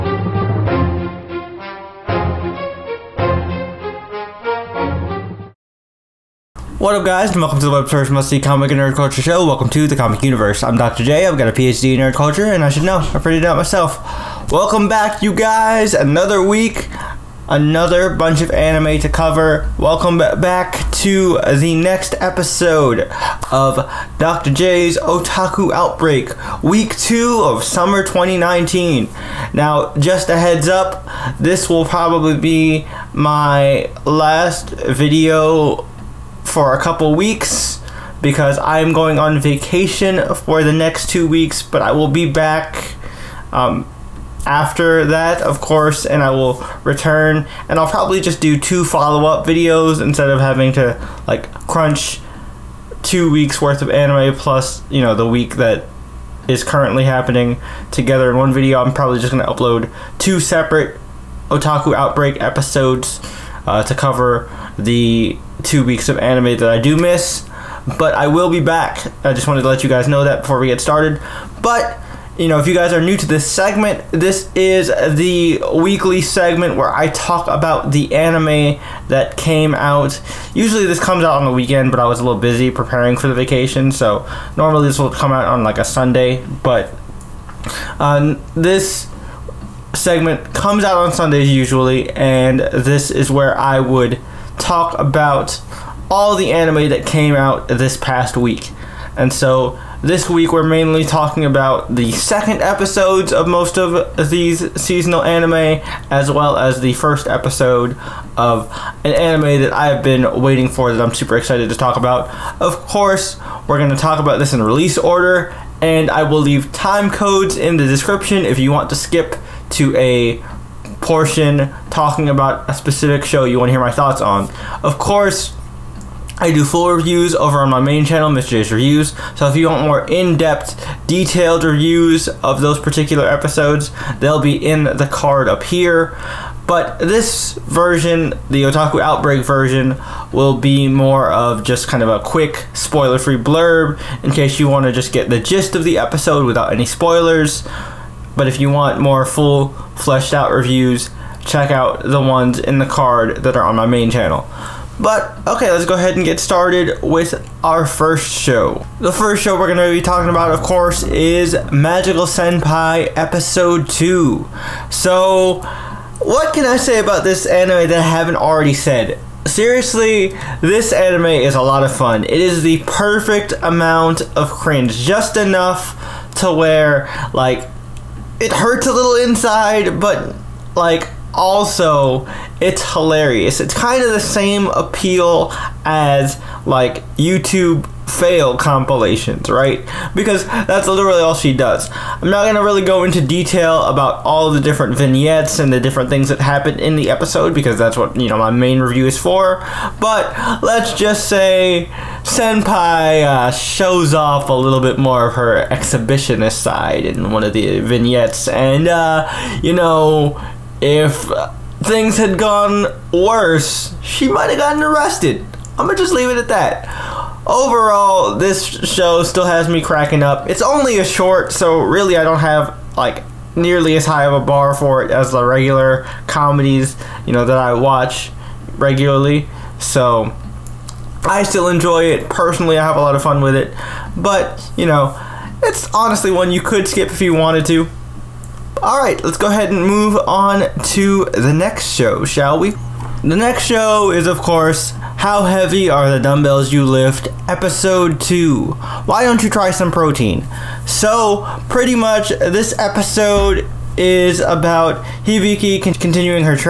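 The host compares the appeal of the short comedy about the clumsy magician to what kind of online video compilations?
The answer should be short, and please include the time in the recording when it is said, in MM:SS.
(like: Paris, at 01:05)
YouTube fail compilations, at 03:07.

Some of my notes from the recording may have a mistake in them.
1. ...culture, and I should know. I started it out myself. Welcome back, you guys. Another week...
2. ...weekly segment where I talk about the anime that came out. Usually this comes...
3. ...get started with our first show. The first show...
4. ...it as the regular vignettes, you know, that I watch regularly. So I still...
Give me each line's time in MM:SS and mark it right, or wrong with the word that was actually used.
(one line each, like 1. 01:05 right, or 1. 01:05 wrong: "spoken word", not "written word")
1. 00:12 wrong: "figured", not "started"
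2. 01:15 right
3. 02:36 right
4. 03:45 wrong: "comedies", not "vignettes".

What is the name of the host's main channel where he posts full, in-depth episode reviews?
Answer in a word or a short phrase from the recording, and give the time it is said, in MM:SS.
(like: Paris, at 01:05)
Mr. J's Reviews, at 02:08.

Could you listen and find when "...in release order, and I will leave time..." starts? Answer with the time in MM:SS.
01:54.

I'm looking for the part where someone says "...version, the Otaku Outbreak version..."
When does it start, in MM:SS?
02:17.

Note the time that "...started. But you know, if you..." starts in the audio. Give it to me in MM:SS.
01:10.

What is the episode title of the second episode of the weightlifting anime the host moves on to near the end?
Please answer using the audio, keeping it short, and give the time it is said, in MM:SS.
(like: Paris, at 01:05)
Why Don't You Try Some Protein?, at 04:09.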